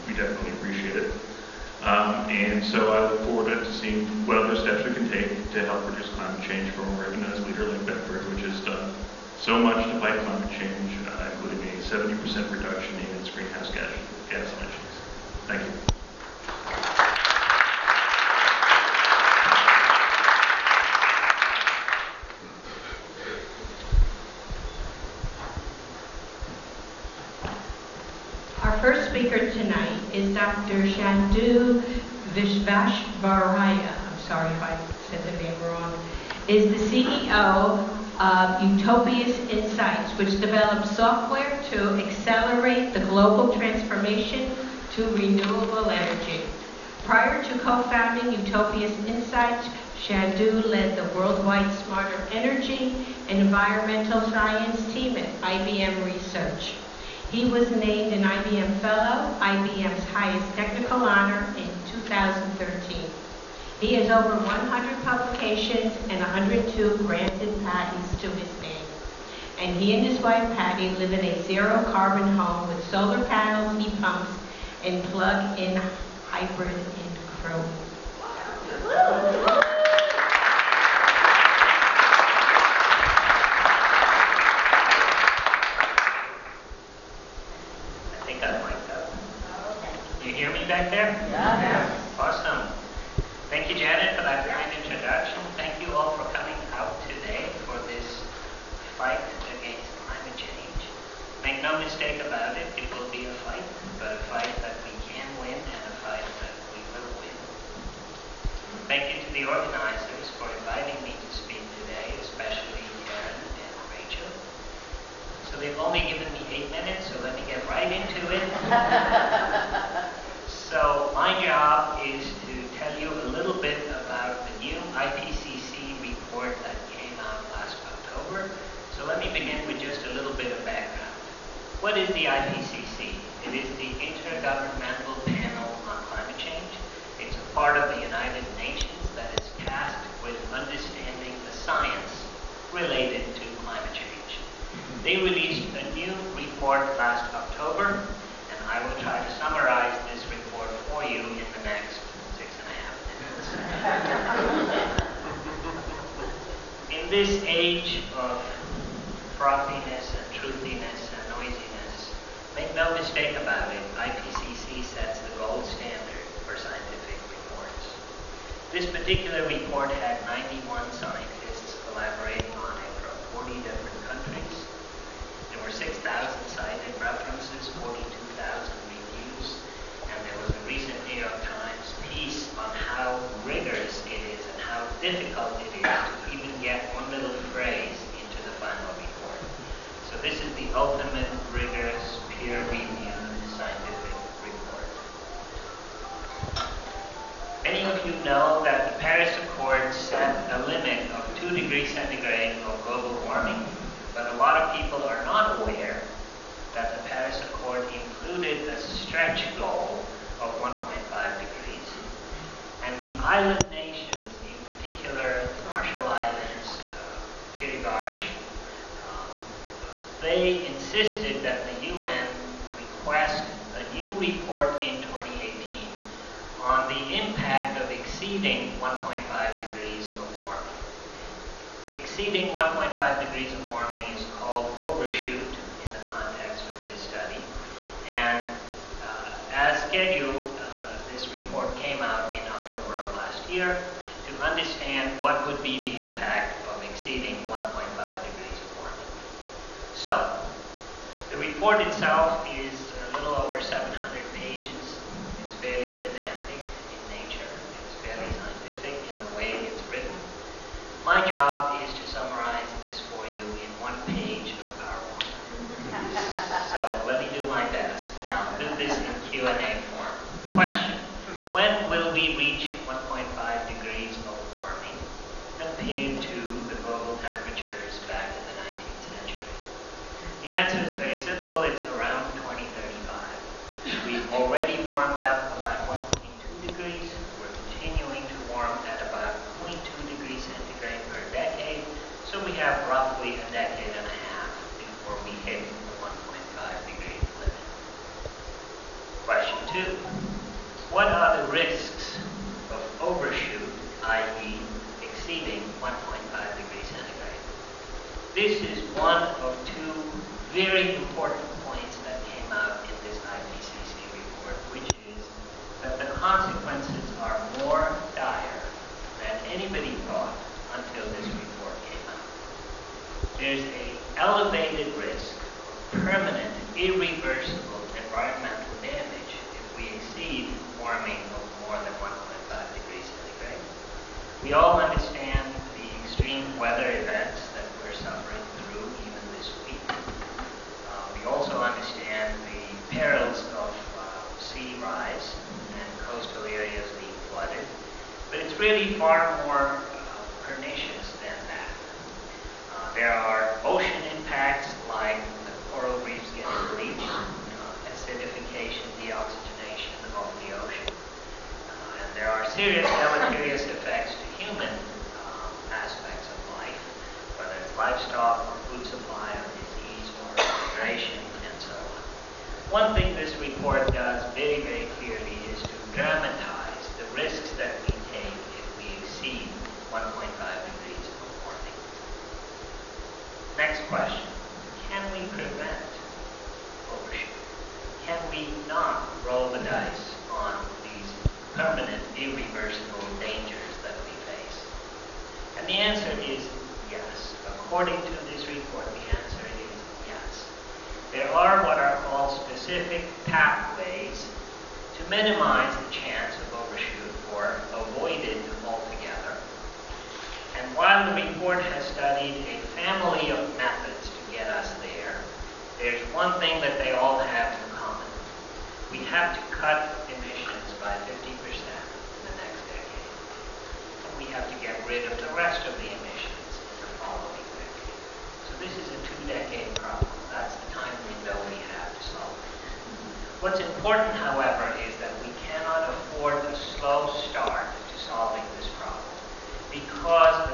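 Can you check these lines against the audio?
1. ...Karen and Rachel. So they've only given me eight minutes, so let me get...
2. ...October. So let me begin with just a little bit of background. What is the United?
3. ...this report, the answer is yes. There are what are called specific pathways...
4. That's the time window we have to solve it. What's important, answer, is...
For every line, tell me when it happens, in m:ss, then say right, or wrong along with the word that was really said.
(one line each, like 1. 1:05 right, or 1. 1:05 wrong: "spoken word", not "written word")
1. 1:53 right
2. 2:07 wrong: "IPCC", not "United"
3. 6:38 right
4. 7:10 wrong: "however", not "answer".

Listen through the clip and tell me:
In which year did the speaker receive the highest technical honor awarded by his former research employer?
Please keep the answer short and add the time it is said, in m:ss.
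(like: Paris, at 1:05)
2013, at 1:01.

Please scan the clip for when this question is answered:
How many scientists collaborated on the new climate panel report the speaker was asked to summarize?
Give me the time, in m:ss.
2:50.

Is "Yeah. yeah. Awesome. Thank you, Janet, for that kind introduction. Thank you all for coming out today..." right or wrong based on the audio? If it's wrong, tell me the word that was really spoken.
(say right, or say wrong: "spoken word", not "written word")
right.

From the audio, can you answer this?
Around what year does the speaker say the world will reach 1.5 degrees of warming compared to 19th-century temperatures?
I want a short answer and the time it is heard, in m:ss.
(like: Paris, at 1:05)
2035, at 4:42.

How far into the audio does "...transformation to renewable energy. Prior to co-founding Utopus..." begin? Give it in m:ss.
0:43.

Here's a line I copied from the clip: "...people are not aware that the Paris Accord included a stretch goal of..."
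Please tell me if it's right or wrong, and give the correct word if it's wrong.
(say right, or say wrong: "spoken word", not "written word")
right.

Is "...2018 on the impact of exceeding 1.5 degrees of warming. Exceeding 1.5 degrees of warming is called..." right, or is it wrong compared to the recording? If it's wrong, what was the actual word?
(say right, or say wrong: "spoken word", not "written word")
right.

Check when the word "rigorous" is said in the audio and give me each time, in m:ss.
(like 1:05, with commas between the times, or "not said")
3:03, 3:11.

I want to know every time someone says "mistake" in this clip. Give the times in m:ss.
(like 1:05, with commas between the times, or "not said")
1:41, 2:42.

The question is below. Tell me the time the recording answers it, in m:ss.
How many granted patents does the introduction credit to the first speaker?
1:06.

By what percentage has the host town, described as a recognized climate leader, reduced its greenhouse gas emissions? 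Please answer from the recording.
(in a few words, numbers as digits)
70%.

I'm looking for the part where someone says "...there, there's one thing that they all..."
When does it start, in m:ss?
6:54.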